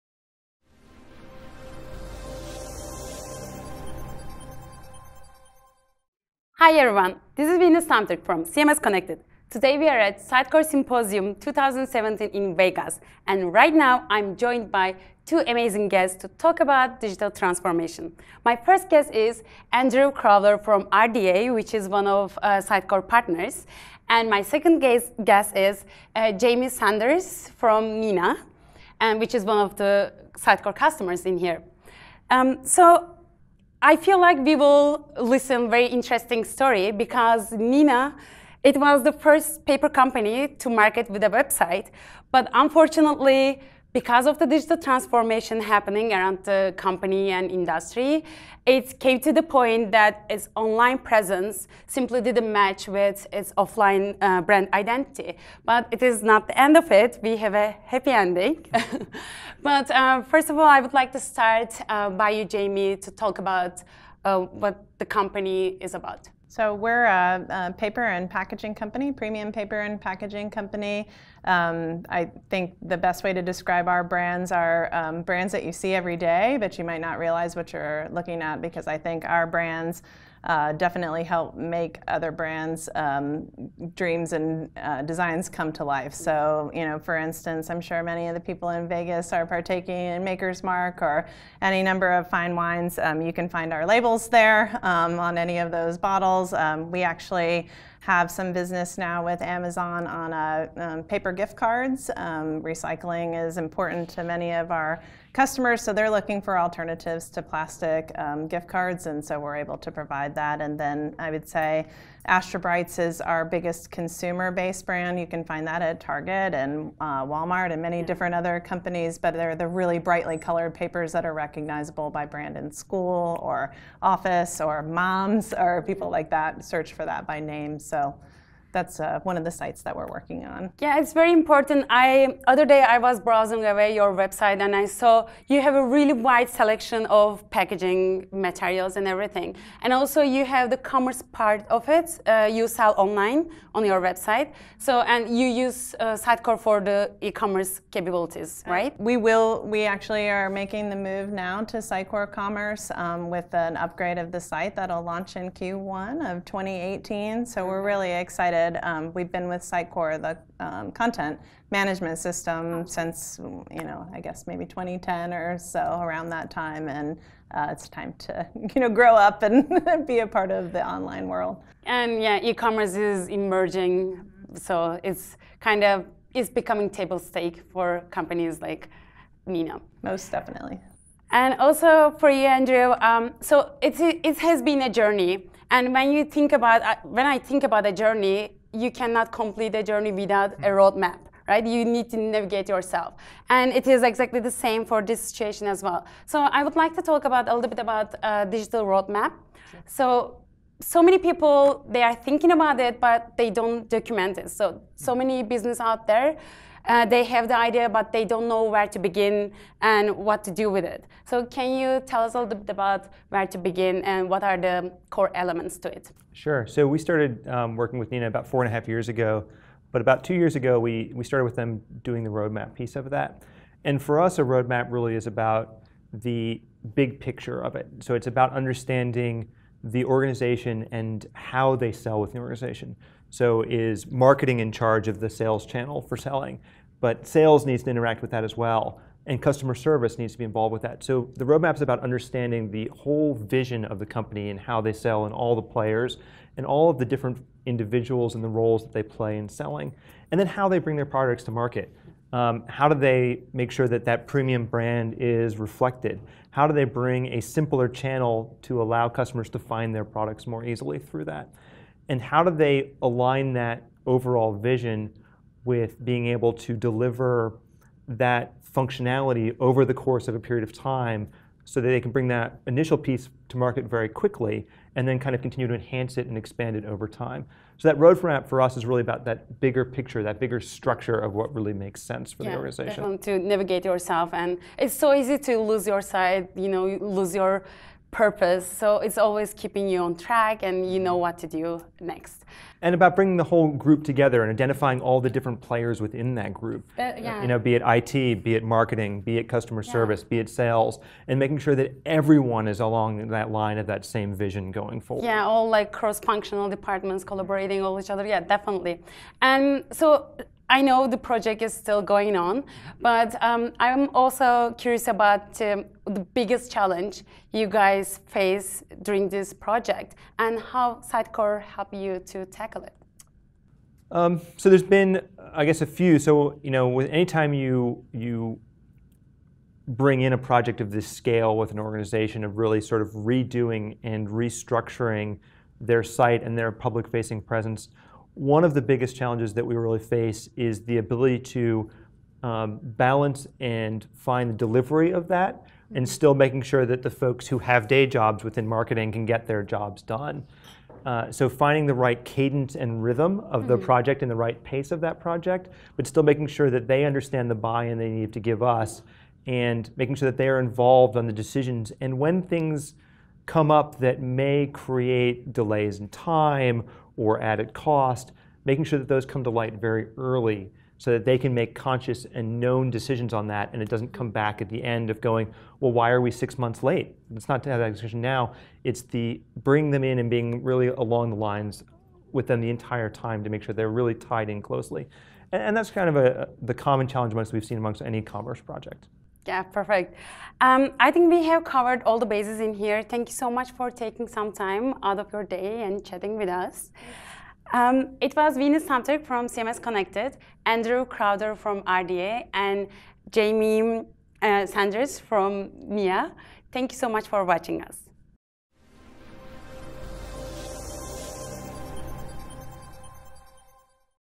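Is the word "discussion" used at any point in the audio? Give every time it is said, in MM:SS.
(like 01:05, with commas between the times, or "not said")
06:17.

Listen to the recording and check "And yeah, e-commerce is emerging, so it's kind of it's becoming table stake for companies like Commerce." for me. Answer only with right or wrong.
wrong.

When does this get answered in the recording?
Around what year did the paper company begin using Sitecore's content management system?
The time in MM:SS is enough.
02:44.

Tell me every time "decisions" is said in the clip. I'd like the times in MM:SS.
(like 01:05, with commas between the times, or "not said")
06:01, 06:12.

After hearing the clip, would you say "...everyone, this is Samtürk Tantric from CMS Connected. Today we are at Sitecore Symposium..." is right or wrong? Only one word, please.
wrong.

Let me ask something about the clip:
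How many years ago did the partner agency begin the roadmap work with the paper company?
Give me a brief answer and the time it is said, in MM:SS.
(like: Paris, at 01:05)
2, at 03:40.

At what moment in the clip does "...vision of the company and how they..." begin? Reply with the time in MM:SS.
04:03.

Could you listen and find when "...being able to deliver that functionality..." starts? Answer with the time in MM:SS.
04:26.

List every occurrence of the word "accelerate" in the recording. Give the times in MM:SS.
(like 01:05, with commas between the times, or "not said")
not said.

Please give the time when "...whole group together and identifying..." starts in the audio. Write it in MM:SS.
04:53.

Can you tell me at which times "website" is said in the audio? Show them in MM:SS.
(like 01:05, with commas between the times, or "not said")
00:41, 02:14, 02:24.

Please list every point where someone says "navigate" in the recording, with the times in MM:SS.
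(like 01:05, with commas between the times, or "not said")
03:12, 04:43.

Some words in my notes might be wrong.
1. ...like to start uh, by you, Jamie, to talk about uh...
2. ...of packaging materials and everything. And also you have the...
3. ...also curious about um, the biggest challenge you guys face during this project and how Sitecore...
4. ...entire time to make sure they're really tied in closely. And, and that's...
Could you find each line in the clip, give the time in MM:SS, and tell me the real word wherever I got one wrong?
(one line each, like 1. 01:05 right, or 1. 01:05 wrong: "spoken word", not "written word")
1. 01:00 right
2. 02:17 right
3. 05:14 right
4. 06:22 right.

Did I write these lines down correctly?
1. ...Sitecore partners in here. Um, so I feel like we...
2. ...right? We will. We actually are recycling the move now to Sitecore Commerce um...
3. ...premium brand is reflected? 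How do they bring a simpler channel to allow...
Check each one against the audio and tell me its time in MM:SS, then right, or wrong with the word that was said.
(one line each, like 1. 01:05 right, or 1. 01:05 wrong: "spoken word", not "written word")
1. 00:30 wrong: "customers", not "partners"
2. 02:28 wrong: "making", not "recycling"
3. 04:14 right.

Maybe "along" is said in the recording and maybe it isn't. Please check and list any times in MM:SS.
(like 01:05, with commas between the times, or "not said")
05:02, 06:20.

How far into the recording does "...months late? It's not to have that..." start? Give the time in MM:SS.
06:16.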